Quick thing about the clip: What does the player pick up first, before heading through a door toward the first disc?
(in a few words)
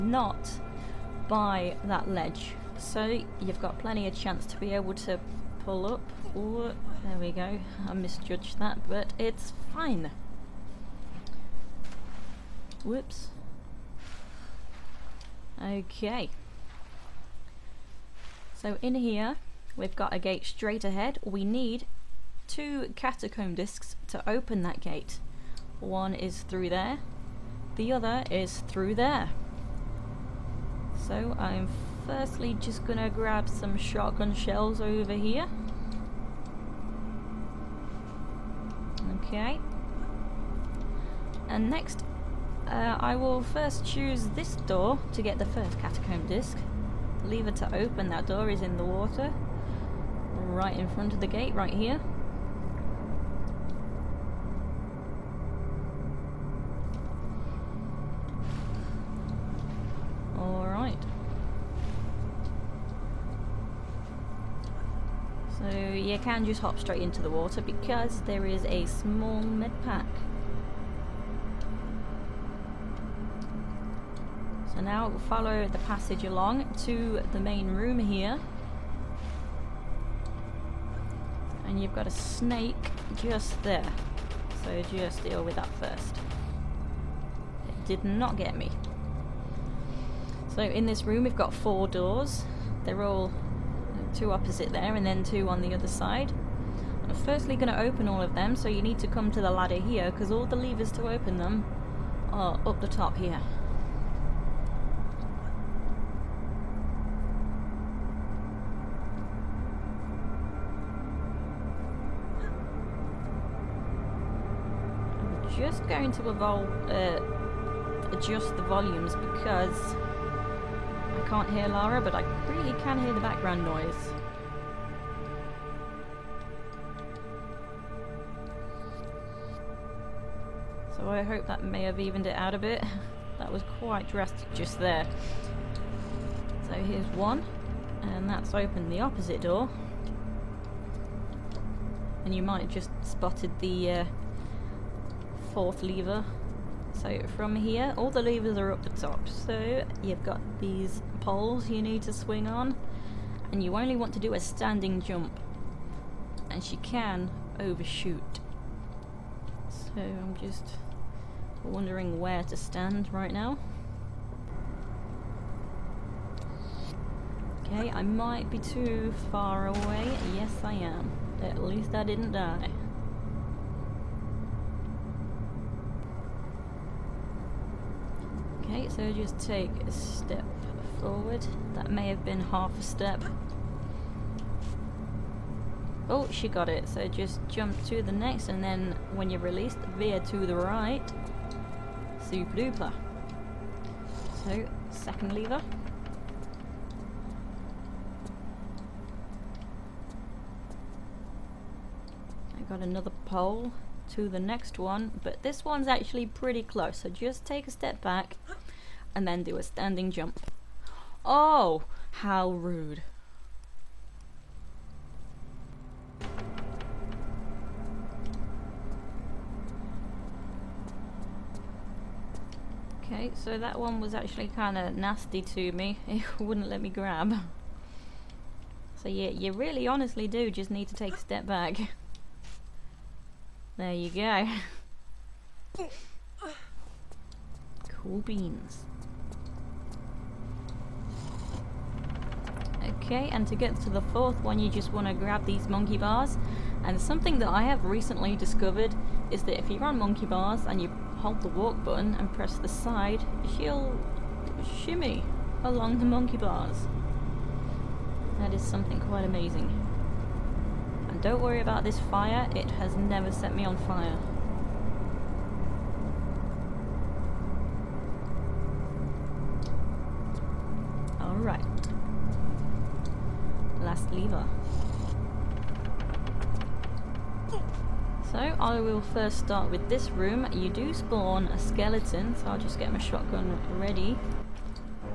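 Shotgun shells.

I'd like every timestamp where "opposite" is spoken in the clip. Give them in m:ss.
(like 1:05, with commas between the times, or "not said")
1:34, 2:18.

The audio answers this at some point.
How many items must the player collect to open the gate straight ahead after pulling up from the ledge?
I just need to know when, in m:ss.
0:22.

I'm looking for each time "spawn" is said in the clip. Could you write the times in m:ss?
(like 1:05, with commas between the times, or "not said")
4:40.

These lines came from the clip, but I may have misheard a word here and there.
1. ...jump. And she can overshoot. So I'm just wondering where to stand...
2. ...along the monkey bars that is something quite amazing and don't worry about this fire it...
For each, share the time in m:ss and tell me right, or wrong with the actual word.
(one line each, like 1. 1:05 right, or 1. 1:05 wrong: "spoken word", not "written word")
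1. 2:35 right
2. 4:15 right.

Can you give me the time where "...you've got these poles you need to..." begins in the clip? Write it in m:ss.
2:30.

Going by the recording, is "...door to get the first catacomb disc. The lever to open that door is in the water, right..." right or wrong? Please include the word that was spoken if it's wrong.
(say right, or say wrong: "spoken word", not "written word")
right.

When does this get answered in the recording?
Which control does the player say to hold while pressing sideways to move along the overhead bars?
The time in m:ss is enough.
4:11.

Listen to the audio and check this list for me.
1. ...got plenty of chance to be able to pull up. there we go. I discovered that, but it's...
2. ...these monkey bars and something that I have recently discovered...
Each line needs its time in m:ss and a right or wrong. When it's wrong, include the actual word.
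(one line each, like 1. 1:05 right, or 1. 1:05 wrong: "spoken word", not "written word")
1. 0:03 wrong: "misjudged", not "discovered"
2. 4:05 right.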